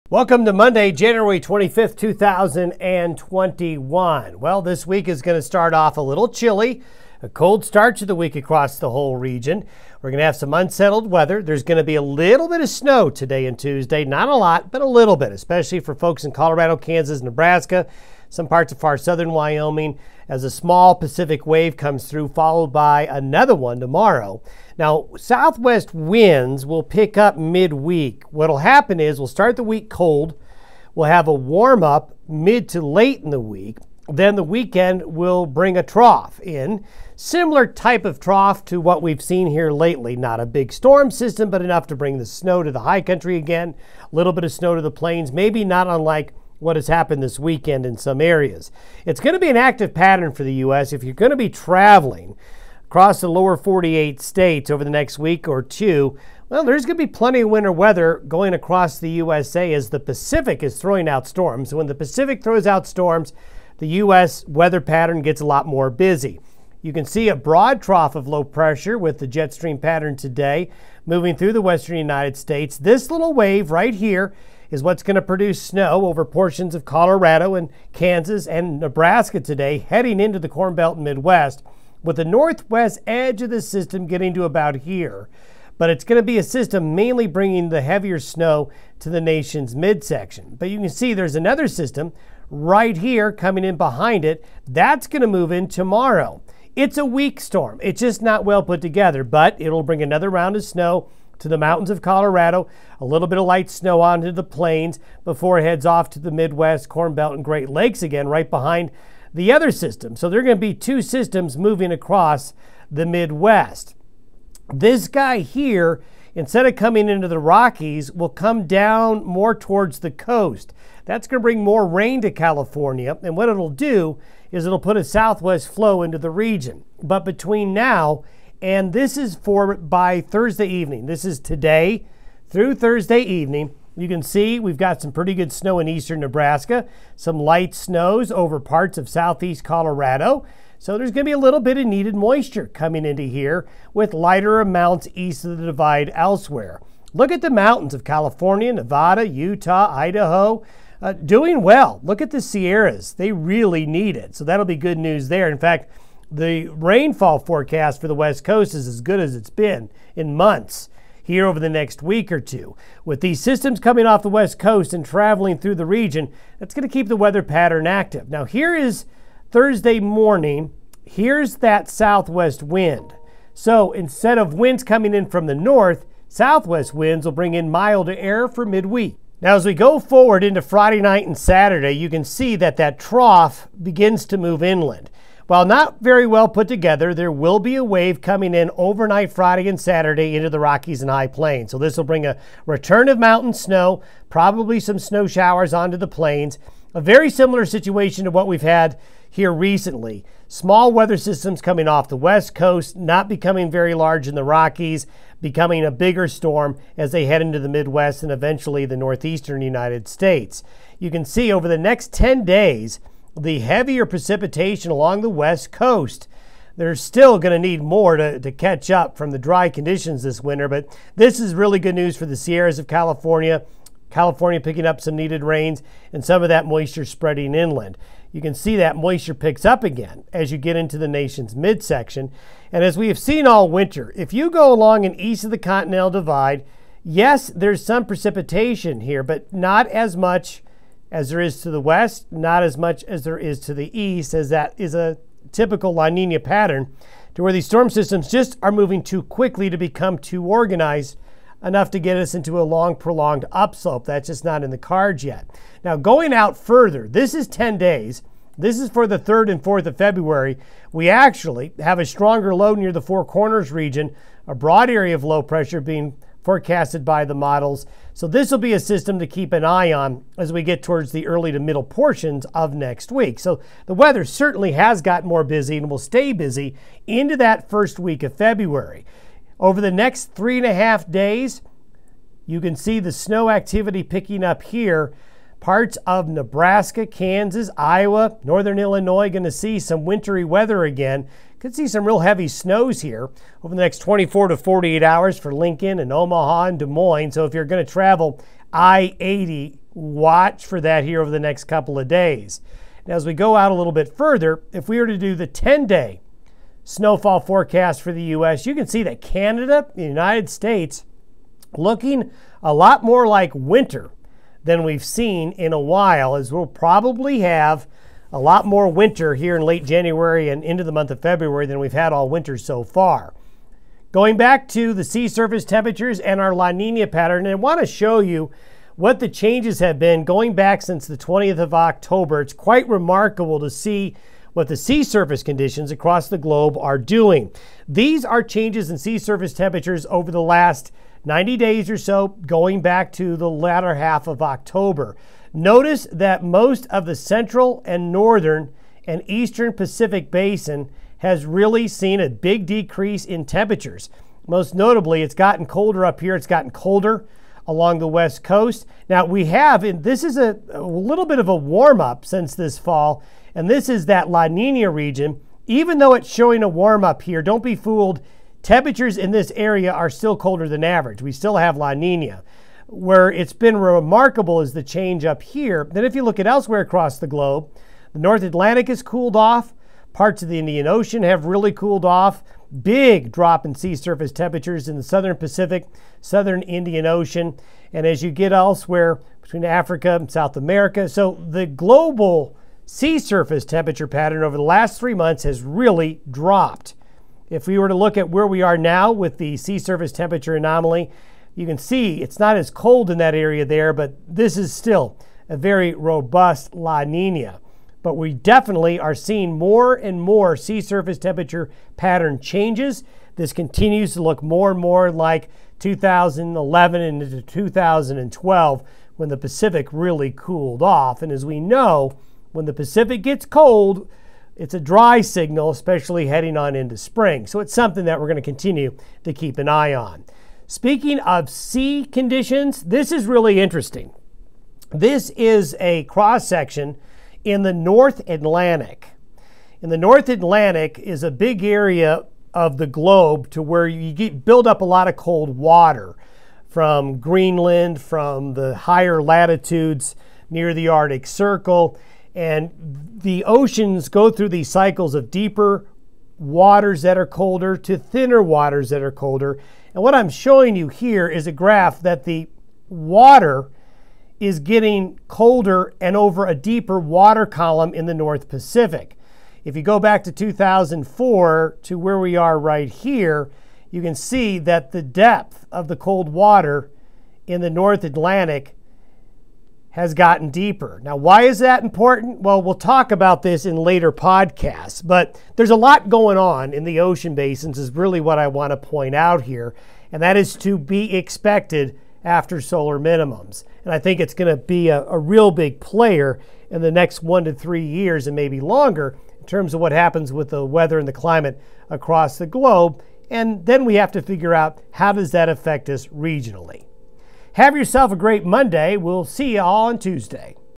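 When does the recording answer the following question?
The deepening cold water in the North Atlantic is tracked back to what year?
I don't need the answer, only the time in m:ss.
7:50.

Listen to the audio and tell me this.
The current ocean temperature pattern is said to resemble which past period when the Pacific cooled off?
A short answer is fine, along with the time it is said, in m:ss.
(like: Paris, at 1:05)
2011 into 2012, at 6:55.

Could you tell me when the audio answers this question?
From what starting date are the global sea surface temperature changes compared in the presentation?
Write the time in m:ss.
5:31.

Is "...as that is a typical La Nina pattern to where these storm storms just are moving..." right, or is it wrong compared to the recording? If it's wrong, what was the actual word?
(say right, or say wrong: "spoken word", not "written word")
wrong: "systems", not "storms".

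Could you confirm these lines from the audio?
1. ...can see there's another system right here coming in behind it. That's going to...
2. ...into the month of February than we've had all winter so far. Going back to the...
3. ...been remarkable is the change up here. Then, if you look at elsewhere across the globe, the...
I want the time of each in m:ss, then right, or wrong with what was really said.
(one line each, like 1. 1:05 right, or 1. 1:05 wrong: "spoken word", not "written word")
1. 1:30 right
2. 5:20 right
3. 6:13 right.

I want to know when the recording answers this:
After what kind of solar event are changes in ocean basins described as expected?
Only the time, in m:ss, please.
8:12.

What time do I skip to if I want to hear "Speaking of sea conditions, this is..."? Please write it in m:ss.
7:10.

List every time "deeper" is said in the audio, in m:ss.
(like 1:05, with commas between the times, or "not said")
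7:35, 7:46, 8:00.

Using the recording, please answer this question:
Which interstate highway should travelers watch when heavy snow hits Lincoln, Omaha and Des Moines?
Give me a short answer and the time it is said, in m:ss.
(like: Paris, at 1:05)
I 80, at 4:58.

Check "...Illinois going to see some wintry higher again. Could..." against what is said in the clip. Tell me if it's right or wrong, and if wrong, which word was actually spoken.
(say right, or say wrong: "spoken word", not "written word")
wrong: "weather", not "higher".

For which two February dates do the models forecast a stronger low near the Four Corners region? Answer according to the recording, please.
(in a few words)
3rd and 4th.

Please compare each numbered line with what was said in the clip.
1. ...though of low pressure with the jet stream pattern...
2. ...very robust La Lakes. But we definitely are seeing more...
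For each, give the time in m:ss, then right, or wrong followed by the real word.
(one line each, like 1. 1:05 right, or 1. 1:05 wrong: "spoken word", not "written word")
1. 1:07 wrong: "trough", not "though"
2. 6:45 wrong: "Nina", not "Lakes".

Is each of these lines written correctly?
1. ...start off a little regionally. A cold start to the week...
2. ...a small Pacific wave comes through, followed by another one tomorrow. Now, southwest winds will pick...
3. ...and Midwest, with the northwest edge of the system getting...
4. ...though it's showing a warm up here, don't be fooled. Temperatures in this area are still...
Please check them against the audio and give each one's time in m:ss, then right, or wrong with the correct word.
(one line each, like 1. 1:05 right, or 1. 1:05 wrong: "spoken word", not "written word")
1. 0:05 wrong: "chilly", not "regionally"
2. 0:20 right
3. 1:20 right
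4. 6:05 right.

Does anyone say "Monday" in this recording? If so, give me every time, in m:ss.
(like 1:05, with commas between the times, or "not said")
0:00, 8:28.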